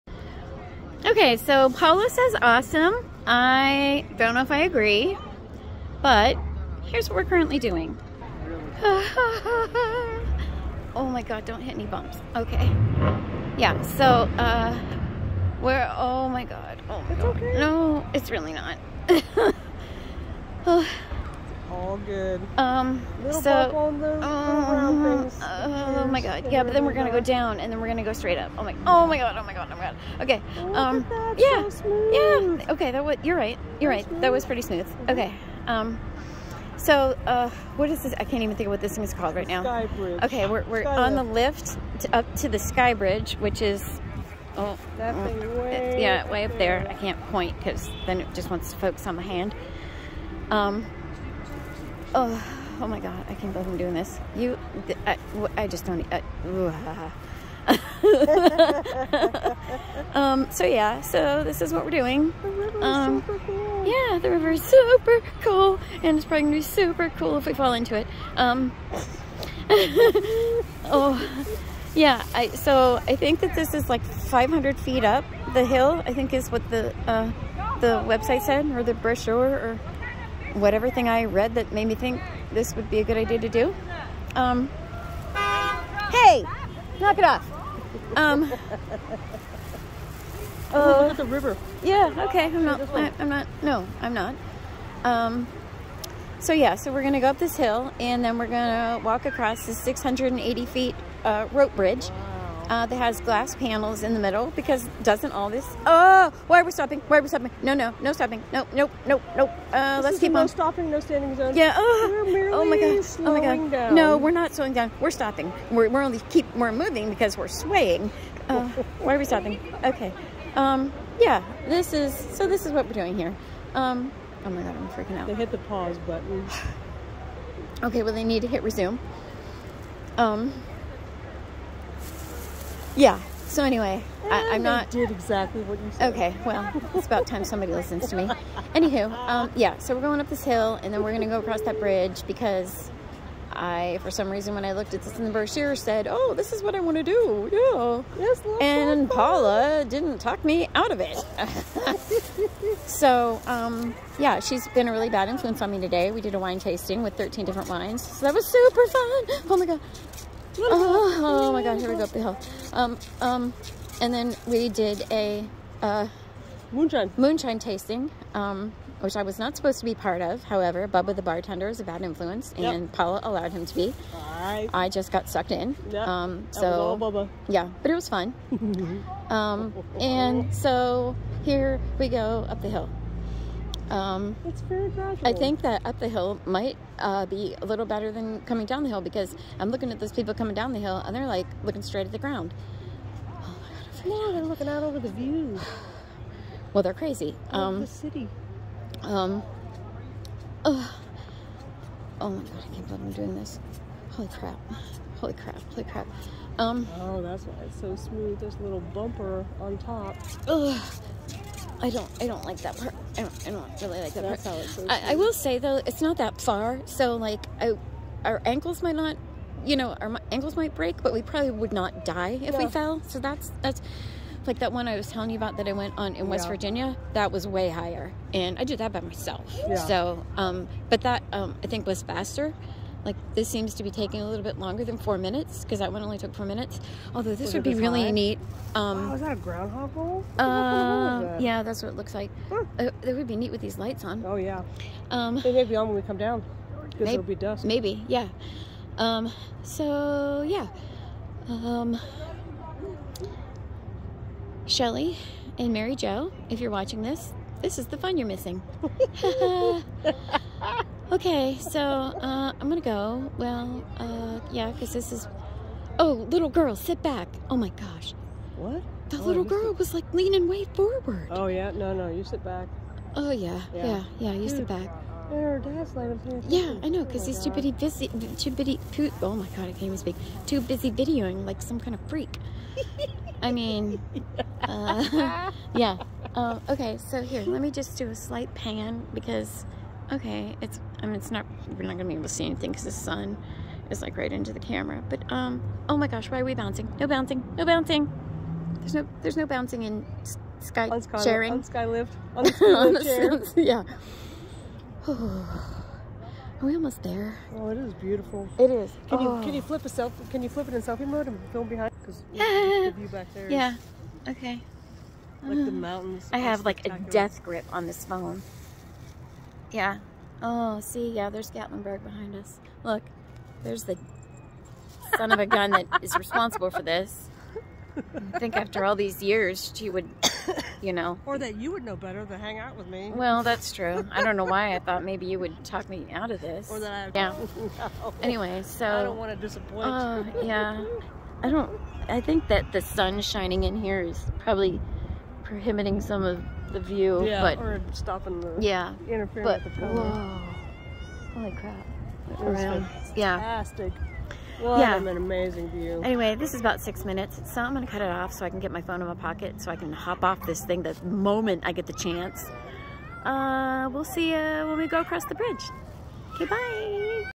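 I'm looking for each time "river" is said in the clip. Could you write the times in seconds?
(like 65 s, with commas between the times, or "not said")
64 s, 91 s.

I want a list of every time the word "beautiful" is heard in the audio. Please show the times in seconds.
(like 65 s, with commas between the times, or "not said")
307 s.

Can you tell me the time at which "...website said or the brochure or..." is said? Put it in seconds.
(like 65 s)
78 s.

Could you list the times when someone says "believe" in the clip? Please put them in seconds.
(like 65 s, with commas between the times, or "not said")
53 s, 202 s.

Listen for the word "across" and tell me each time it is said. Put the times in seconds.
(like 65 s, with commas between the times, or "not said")
99 s, 141 s, 365 s.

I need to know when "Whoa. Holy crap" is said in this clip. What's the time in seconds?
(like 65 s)
350 s.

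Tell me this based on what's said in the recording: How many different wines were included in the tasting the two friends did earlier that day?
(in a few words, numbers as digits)
13.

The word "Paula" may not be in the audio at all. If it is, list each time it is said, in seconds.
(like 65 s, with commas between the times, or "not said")
1 s, 149 s, 172 s.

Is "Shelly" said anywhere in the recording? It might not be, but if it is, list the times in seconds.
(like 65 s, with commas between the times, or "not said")
254 s.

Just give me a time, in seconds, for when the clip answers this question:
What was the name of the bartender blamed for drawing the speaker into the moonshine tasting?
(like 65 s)
170 s.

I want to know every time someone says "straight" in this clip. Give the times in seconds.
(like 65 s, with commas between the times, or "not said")
28 s, 191 s.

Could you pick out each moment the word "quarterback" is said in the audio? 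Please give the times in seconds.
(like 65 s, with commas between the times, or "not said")
not said.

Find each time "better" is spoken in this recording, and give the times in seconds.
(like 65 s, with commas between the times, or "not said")
187 s, 331 s.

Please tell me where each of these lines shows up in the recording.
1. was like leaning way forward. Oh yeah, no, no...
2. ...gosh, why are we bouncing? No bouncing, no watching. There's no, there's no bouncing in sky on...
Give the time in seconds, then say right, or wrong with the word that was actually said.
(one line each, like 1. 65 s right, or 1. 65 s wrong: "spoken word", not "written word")
1. 269 s right
2. 296 s wrong: "bouncing", not "watching".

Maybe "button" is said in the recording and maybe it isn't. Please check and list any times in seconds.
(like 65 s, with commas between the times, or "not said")
126 s.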